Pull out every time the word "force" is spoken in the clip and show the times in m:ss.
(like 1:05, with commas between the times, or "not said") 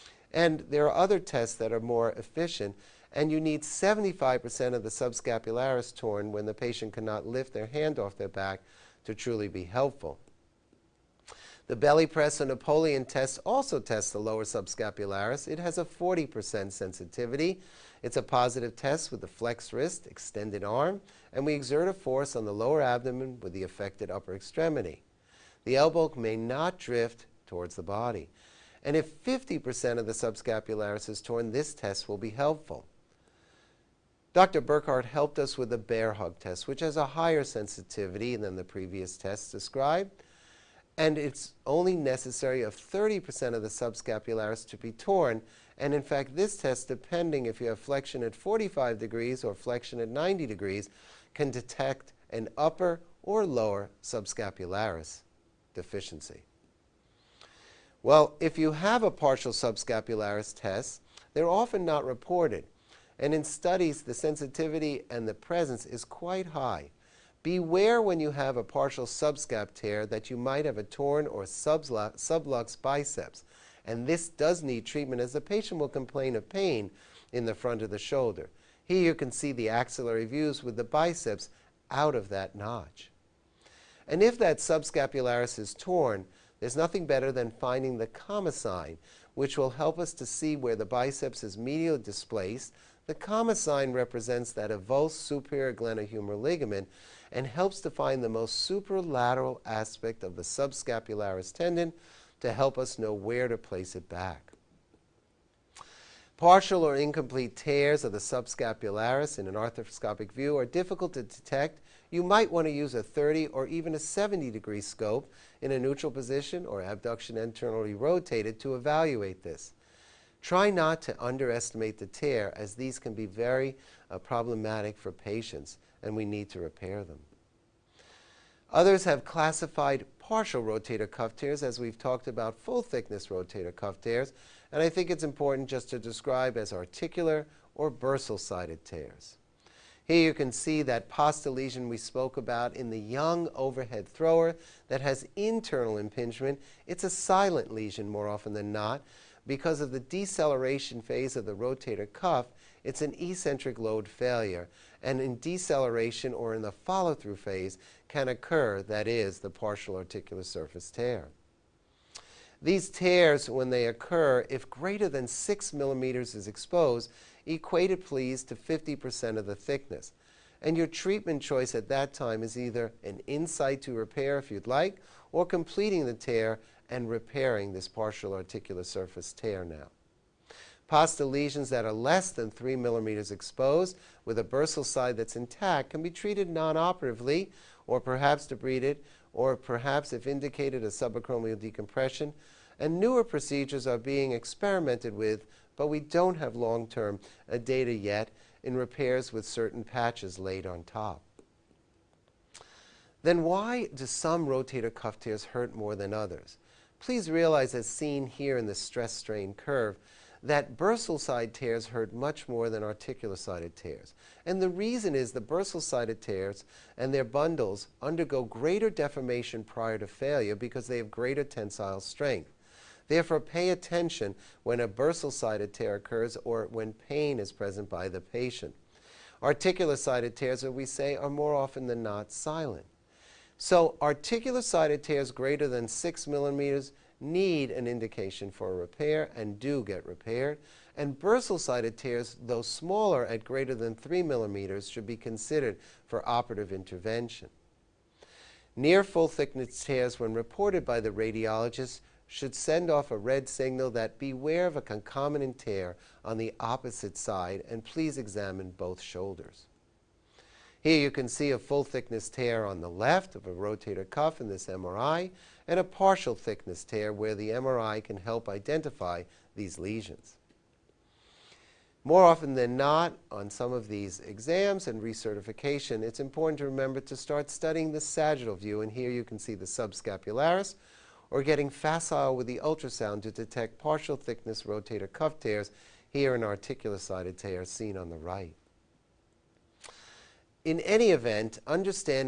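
0:21.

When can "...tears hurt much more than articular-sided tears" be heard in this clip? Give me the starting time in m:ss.
3:31.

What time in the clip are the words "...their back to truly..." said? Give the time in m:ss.
0:08.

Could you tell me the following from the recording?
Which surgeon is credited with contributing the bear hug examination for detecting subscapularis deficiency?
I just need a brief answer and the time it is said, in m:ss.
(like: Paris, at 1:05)
Dr. Burkhart, at 0:34.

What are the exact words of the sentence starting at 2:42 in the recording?
These tears, when they occur, if greater than 6 millimeters is exposed, equate it please to 50% of the thickness.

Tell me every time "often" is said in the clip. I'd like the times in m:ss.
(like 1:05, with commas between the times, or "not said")
1:01, 2:28, 3:51, 4:32.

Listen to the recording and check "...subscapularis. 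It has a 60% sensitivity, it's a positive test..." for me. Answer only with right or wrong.
wrong.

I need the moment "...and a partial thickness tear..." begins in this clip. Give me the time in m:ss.
4:25.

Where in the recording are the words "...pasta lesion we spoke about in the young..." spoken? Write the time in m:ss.
2:21.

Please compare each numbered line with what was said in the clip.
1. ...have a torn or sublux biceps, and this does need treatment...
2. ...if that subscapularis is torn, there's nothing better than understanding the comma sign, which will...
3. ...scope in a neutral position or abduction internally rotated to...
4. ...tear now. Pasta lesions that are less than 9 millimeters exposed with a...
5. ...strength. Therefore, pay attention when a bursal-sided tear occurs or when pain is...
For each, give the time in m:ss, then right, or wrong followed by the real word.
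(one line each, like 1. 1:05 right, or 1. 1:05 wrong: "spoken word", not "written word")
1. 1:10 right
2. 1:24 wrong: "finding", not "understanding"
3. 1:54 right
4. 2:59 wrong: "3", not "9"
5. 3:42 right.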